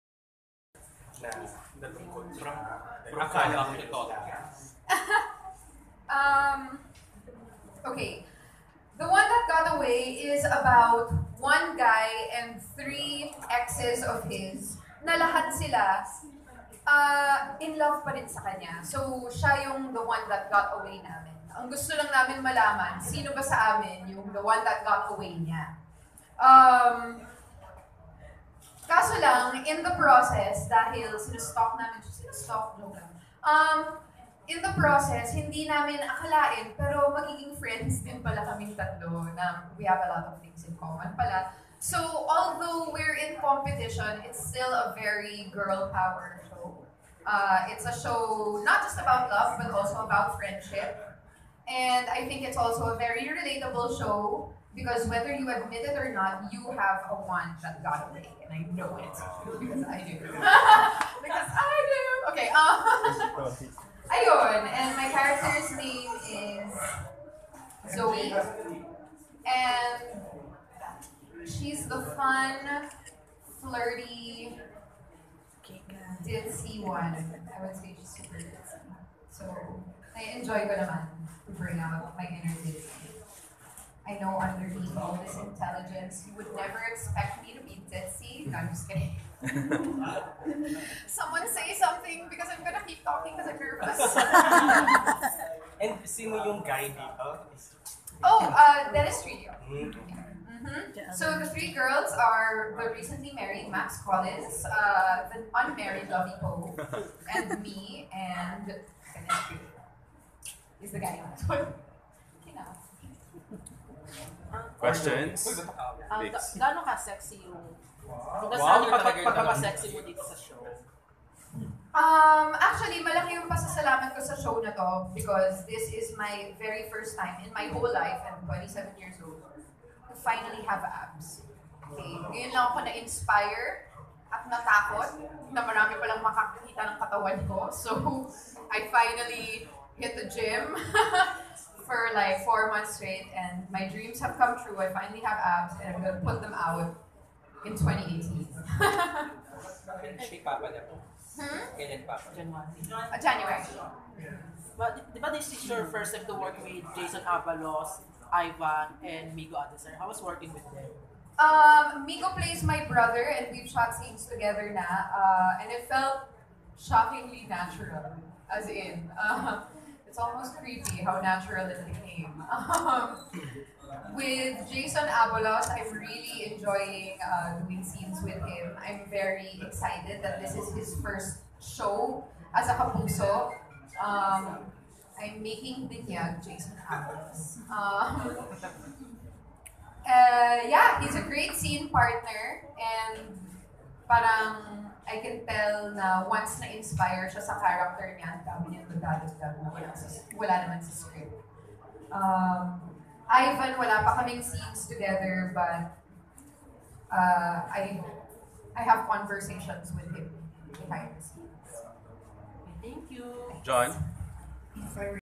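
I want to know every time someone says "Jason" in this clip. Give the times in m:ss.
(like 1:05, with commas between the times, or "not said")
2:36, 2:54, 3:06.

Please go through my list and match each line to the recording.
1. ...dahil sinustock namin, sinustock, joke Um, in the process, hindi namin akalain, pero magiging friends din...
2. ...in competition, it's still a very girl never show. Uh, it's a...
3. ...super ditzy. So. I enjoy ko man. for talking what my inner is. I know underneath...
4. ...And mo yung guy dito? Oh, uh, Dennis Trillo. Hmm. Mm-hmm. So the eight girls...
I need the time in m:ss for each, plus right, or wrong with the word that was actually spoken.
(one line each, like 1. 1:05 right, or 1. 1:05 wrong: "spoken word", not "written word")
1. 0:30 right
2. 0:43 wrong: "power", not "never"
3. 1:18 wrong: "bring", not "talking"
4. 1:35 wrong: "three", not "eight".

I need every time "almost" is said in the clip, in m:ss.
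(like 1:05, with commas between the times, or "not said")
2:50.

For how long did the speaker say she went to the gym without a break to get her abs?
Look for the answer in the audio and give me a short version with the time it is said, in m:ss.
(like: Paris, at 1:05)
4 months, at 2:22.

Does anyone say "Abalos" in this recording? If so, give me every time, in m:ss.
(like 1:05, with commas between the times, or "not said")
2:37, 2:55, 3:06.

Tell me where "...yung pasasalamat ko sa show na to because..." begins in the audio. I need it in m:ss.
2:03.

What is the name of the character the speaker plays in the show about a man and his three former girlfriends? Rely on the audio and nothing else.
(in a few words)
Zoe.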